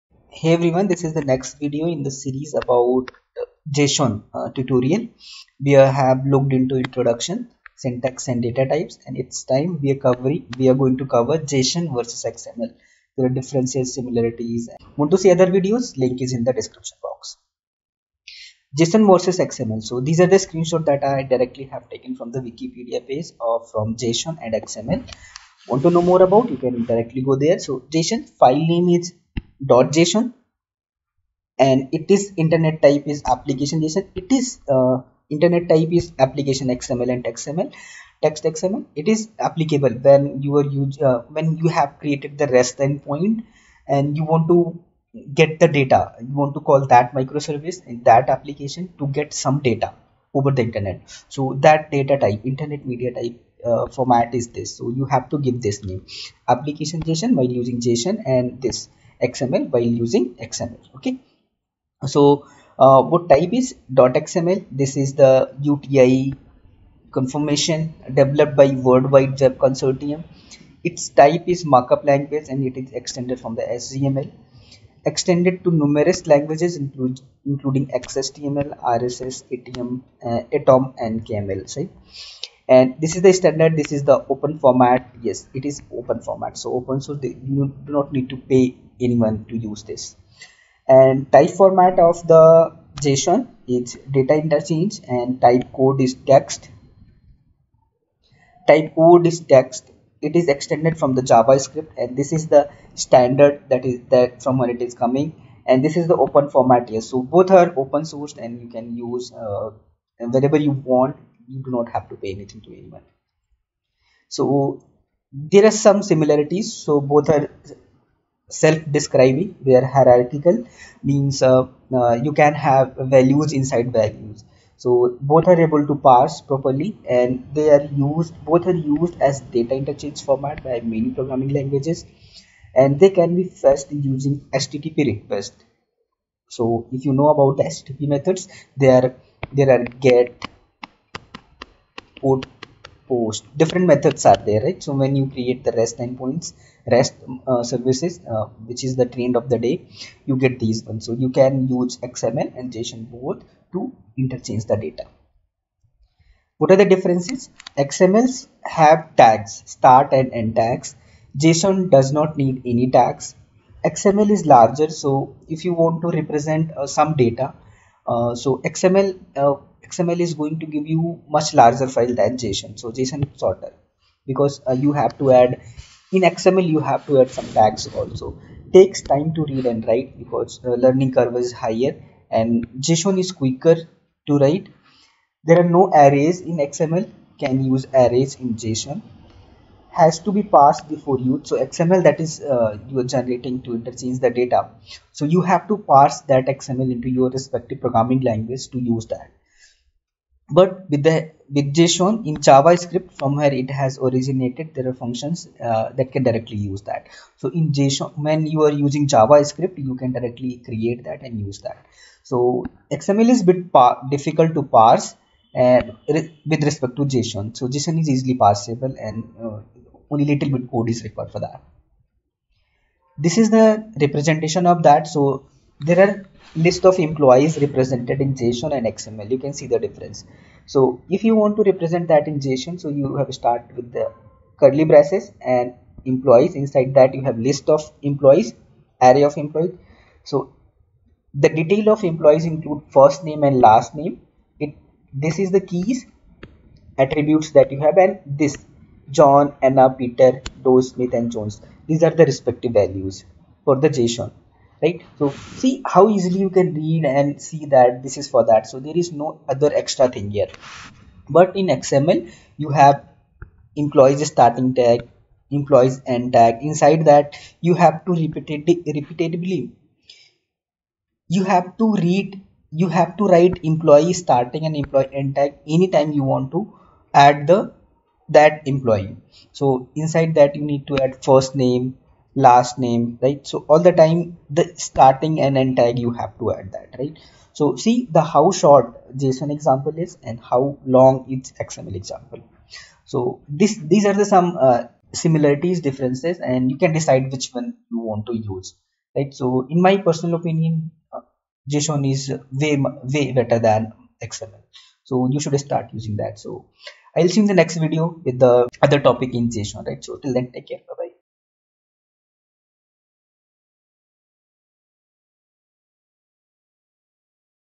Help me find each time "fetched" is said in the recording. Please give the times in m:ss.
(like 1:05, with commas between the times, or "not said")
2:13.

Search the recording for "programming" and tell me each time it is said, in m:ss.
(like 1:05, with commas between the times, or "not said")
2:11, 3:17.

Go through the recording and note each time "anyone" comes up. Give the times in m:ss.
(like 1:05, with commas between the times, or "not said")
1:29, 1:52.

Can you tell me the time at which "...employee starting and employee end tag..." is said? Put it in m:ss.
4:33.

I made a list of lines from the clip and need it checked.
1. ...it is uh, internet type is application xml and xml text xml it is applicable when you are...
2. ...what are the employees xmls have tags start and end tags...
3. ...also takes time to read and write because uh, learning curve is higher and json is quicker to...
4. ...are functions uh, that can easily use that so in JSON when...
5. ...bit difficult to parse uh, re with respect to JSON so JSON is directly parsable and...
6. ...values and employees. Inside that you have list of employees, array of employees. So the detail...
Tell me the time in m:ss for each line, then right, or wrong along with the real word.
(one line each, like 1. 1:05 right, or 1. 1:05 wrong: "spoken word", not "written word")
1. 0:34 right
2. 2:36 wrong: "differences", not "employees"
3. 2:58 right
4. 3:24 wrong: "directly", not "easily"
5. 3:33 wrong: "easily", not "directly"
6. 3:54 wrong: "braces", not "values".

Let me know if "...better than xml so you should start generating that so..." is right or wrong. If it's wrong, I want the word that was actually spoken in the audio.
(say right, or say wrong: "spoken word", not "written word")
wrong: "using", not "generating".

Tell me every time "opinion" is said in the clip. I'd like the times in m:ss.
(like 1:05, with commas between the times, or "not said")
5:00.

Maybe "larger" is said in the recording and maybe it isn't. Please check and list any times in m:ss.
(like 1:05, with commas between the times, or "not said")
2:44, 2:51.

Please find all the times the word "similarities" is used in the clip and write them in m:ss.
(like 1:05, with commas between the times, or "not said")
0:13, 1:56, 4:55.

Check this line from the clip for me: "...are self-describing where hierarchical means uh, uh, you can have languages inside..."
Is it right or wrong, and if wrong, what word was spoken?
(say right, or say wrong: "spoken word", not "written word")
wrong: "values", not "languages".